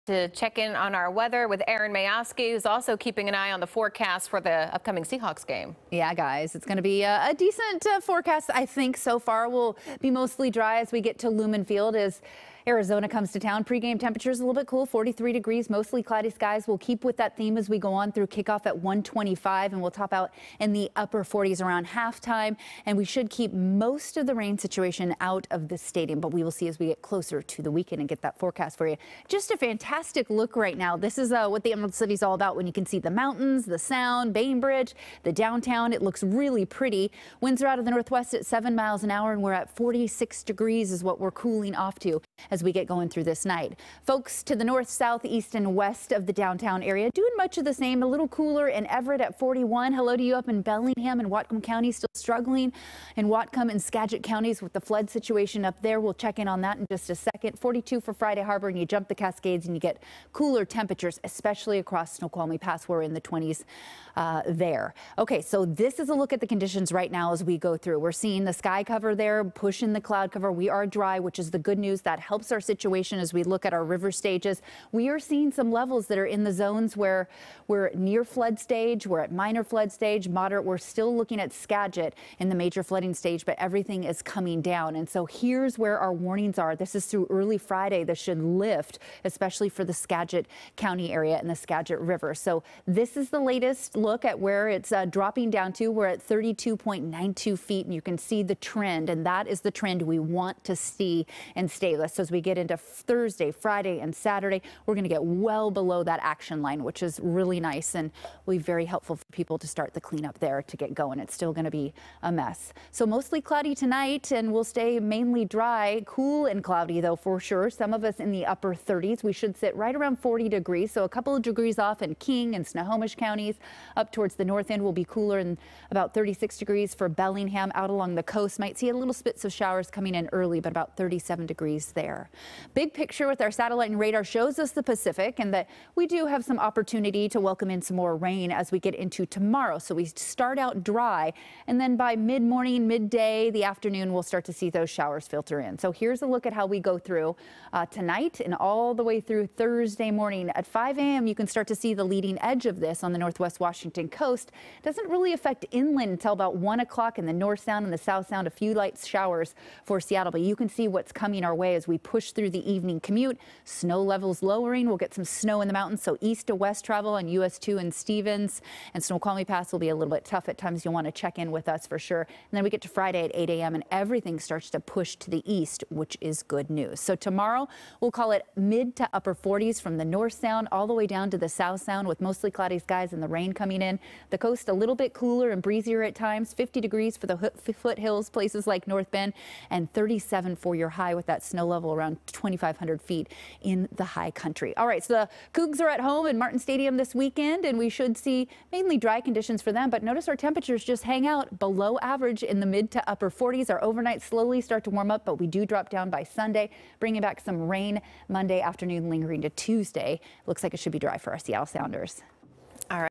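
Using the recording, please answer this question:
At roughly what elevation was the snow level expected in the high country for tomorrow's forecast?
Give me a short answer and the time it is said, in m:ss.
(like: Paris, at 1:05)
2,500 feet, at 3:12.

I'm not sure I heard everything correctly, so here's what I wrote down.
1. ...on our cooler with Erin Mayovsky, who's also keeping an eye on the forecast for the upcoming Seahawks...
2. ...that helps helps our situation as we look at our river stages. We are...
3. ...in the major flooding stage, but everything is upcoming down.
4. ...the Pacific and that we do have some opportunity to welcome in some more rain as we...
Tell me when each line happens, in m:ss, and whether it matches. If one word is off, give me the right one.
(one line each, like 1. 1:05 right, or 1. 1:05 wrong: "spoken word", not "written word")
1. 0:00 wrong: "weather", not "cooler"
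2. 1:12 right
3. 1:22 wrong: "coming", not "upcoming"
4. 2:14 right.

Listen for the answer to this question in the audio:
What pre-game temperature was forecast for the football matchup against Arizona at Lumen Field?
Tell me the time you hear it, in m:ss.
0:14.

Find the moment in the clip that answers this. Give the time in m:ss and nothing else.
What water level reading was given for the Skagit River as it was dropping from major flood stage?
1:36.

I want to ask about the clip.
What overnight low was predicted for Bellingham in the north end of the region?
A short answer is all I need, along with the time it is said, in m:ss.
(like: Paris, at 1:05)
36 degrees, at 2:06.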